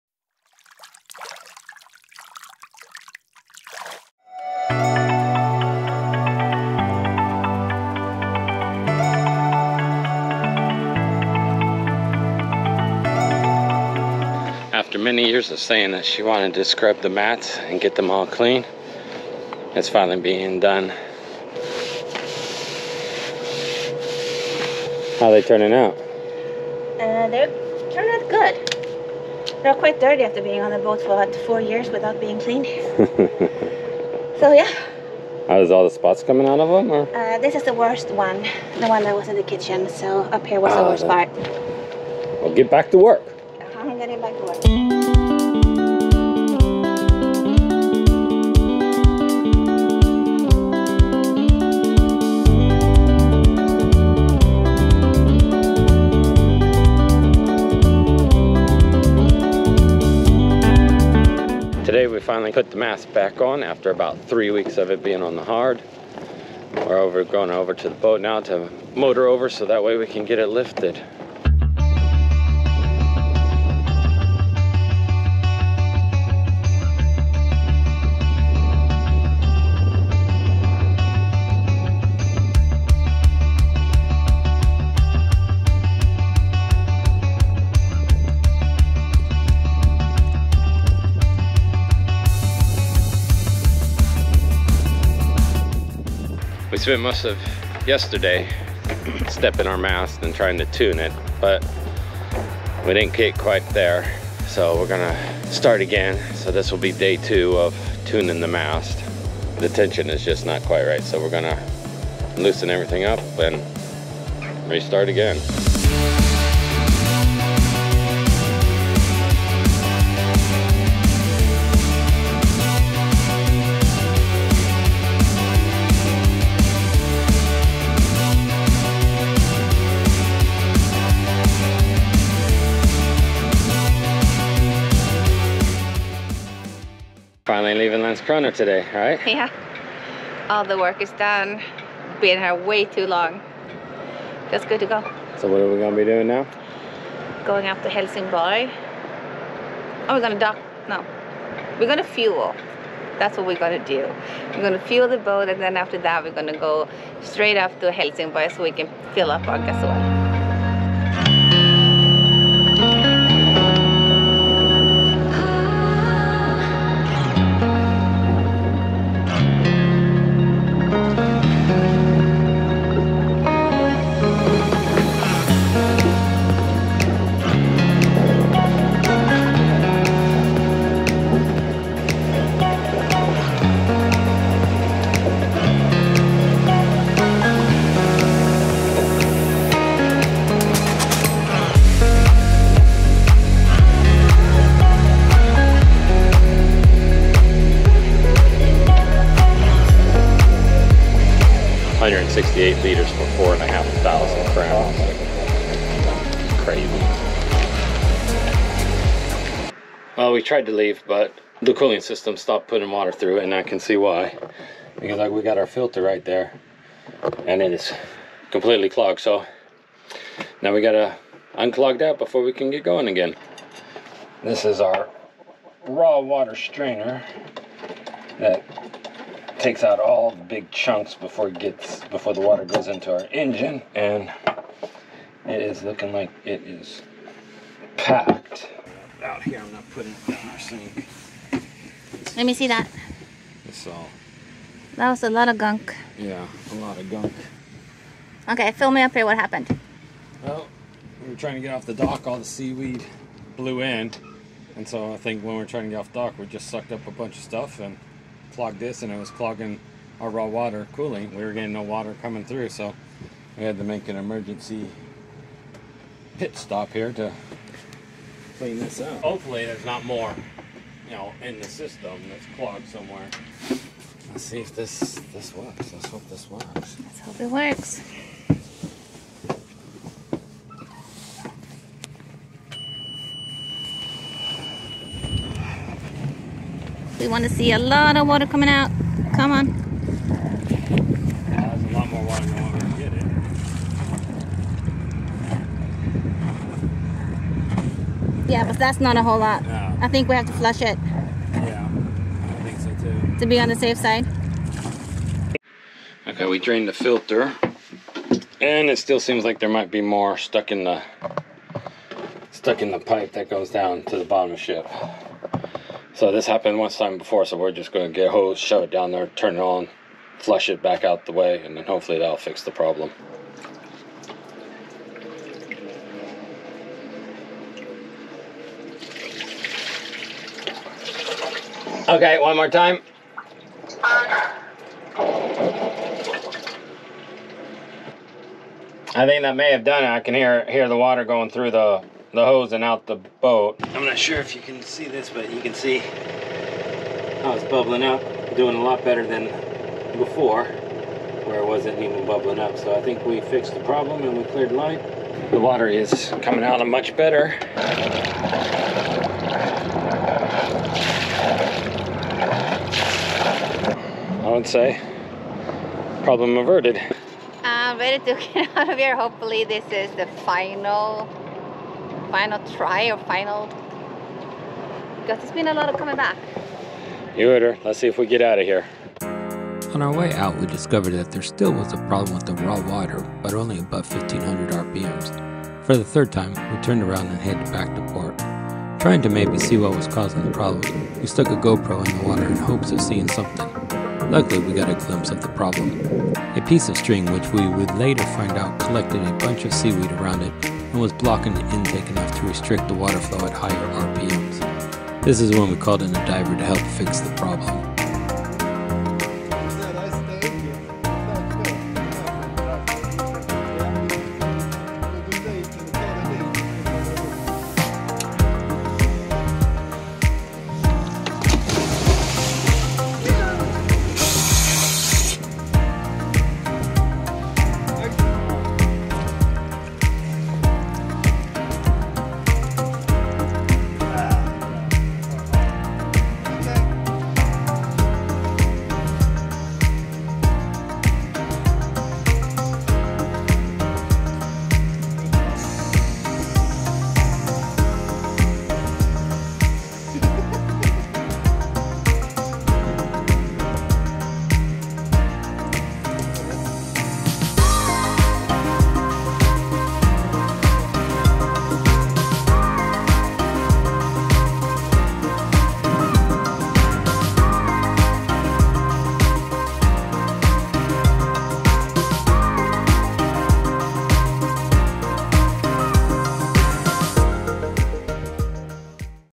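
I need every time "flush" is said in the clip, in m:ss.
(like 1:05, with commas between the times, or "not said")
5:00, 5:20.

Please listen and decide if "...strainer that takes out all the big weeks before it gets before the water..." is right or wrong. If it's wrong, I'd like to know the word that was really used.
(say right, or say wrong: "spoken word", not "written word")
wrong: "chunks", not "weeks".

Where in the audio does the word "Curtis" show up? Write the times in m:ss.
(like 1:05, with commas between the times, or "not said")
not said.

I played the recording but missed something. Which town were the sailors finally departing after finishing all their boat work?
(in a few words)
Landskrona.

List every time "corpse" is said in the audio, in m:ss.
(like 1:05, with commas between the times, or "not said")
not said.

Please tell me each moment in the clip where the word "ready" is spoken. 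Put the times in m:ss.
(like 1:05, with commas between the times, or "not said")
6:07.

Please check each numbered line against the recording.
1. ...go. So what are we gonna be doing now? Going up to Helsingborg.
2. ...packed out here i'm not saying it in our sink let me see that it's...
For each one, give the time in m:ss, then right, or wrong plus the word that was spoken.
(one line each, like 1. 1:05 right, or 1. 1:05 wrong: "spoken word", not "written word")
1. 2:24 right
2. 3:57 wrong: "putting", not "saying".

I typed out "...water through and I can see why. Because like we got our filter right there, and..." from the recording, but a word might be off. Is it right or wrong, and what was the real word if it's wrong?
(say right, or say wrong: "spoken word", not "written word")
right.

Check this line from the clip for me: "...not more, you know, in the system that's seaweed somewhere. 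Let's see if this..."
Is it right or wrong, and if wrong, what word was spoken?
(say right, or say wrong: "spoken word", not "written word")
wrong: "clogged", not "seaweed".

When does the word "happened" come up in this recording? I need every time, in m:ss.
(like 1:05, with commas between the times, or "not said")
4:09, 5:16.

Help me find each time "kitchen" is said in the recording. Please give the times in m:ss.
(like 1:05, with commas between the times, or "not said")
0:39.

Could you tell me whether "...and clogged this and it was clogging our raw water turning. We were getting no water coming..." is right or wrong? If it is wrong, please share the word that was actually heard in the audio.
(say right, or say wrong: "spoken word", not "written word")
wrong: "cooling", not "turning".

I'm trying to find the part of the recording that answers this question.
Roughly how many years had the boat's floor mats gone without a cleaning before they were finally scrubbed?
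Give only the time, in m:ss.
0:31.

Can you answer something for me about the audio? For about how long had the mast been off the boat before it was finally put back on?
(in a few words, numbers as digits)
3 weeks.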